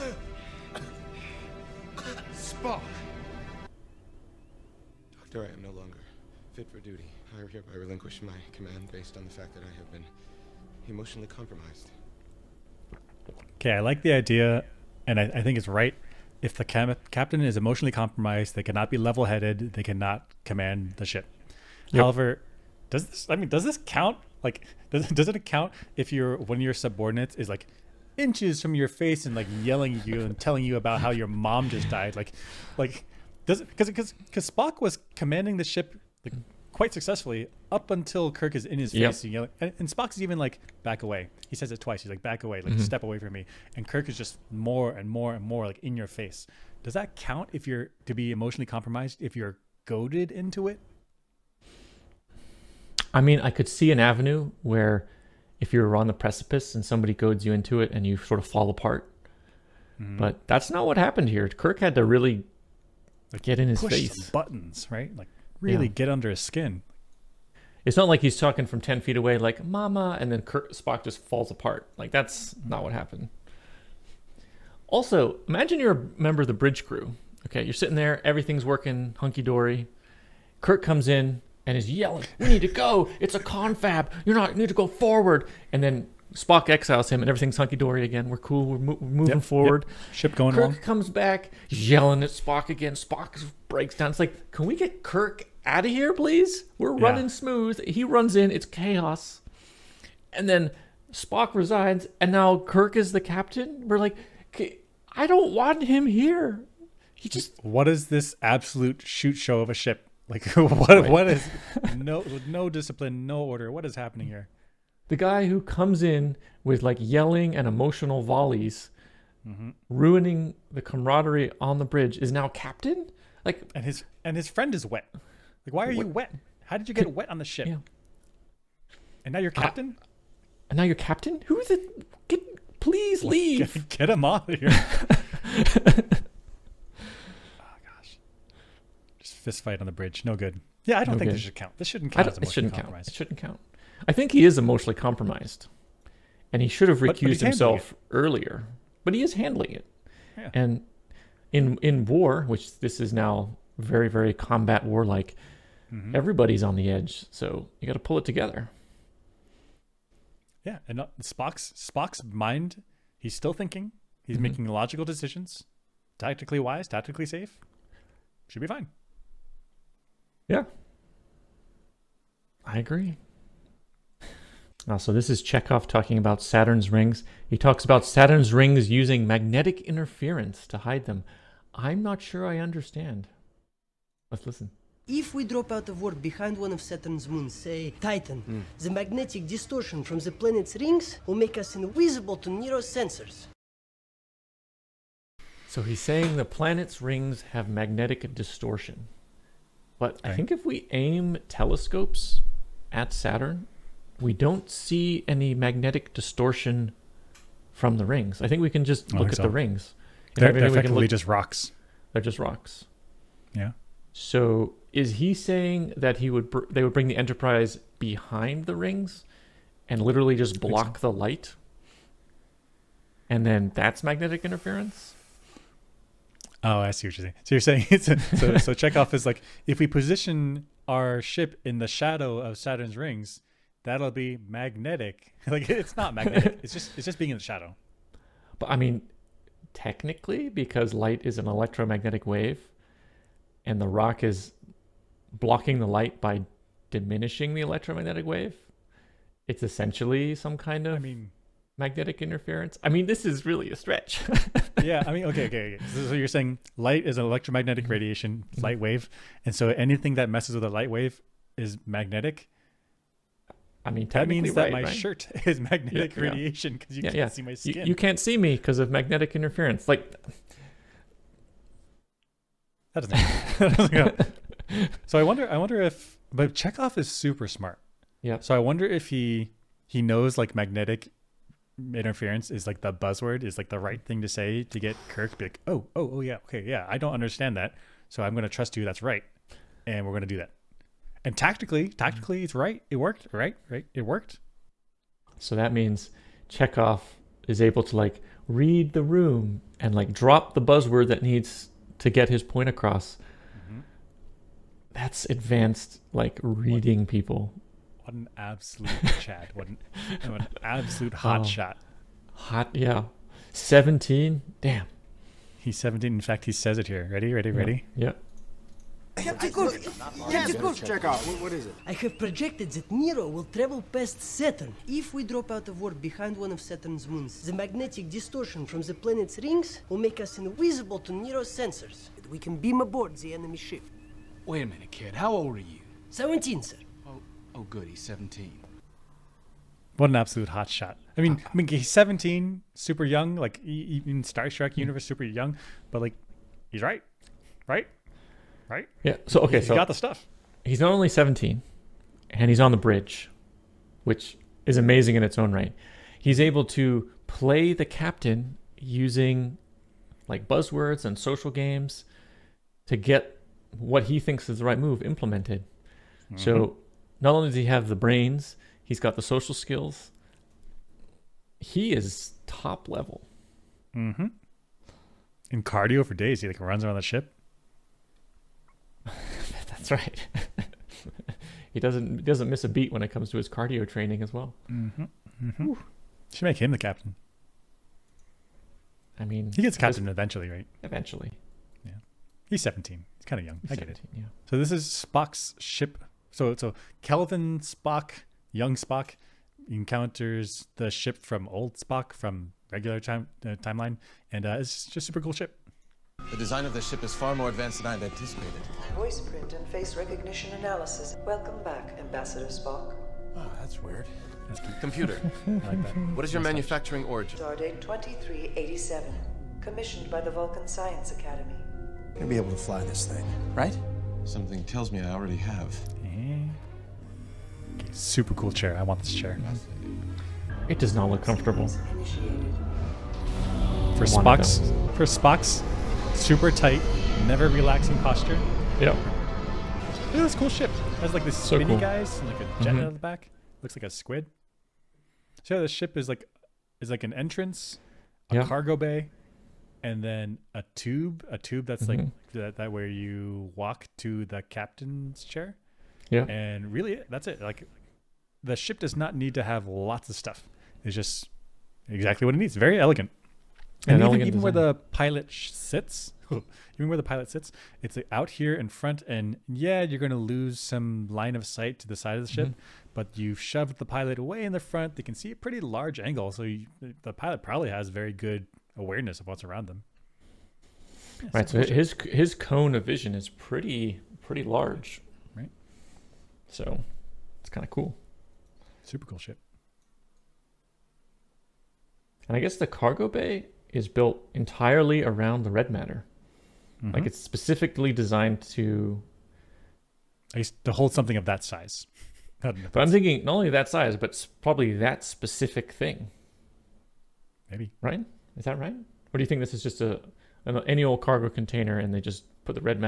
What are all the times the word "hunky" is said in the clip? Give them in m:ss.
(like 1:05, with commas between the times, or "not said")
1:19, 1:27.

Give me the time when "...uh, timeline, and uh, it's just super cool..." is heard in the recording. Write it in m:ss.
6:43.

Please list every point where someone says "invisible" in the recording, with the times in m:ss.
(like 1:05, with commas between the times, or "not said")
3:11, 5:30.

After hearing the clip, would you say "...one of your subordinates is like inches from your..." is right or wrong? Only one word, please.
right.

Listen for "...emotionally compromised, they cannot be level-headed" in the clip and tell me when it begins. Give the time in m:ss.
0:17.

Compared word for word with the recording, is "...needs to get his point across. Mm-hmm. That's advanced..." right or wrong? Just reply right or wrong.
right.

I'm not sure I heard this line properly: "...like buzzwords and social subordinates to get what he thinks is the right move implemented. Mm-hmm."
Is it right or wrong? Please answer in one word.
wrong.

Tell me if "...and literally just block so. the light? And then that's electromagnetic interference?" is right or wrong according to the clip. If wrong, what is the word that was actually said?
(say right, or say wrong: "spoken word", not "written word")
wrong: "magnetic", not "electromagnetic".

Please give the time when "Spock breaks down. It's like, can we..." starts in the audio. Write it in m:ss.
1:32.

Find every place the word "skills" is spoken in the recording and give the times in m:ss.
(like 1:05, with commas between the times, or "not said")
6:09.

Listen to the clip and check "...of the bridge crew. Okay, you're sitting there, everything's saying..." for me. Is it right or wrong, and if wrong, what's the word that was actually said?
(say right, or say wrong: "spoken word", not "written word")
wrong: "working", not "saying".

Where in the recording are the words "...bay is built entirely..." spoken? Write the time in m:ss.
8:13.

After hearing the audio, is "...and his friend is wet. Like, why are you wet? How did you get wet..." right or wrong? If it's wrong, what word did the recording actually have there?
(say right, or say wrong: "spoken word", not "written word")
right.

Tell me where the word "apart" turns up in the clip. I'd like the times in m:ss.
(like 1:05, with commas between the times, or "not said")
0:58, 1:11.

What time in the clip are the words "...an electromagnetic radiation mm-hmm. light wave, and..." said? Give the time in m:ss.
4:17.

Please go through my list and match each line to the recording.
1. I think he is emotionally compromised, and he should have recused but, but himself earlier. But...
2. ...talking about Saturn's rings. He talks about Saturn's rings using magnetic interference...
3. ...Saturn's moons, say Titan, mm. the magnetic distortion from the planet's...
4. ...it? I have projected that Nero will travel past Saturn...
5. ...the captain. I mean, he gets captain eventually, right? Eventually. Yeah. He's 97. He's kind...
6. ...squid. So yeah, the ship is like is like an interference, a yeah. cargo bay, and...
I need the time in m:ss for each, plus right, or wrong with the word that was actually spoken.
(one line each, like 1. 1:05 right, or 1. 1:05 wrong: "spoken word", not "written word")
1. 2:24 right
2. 2:55 right
3. 3:06 right
4. 5:21 right
5. 6:26 wrong: "17", not "97"
6. 7:24 wrong: "entrance", not "interference".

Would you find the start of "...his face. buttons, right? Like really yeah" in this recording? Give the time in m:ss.
1:03.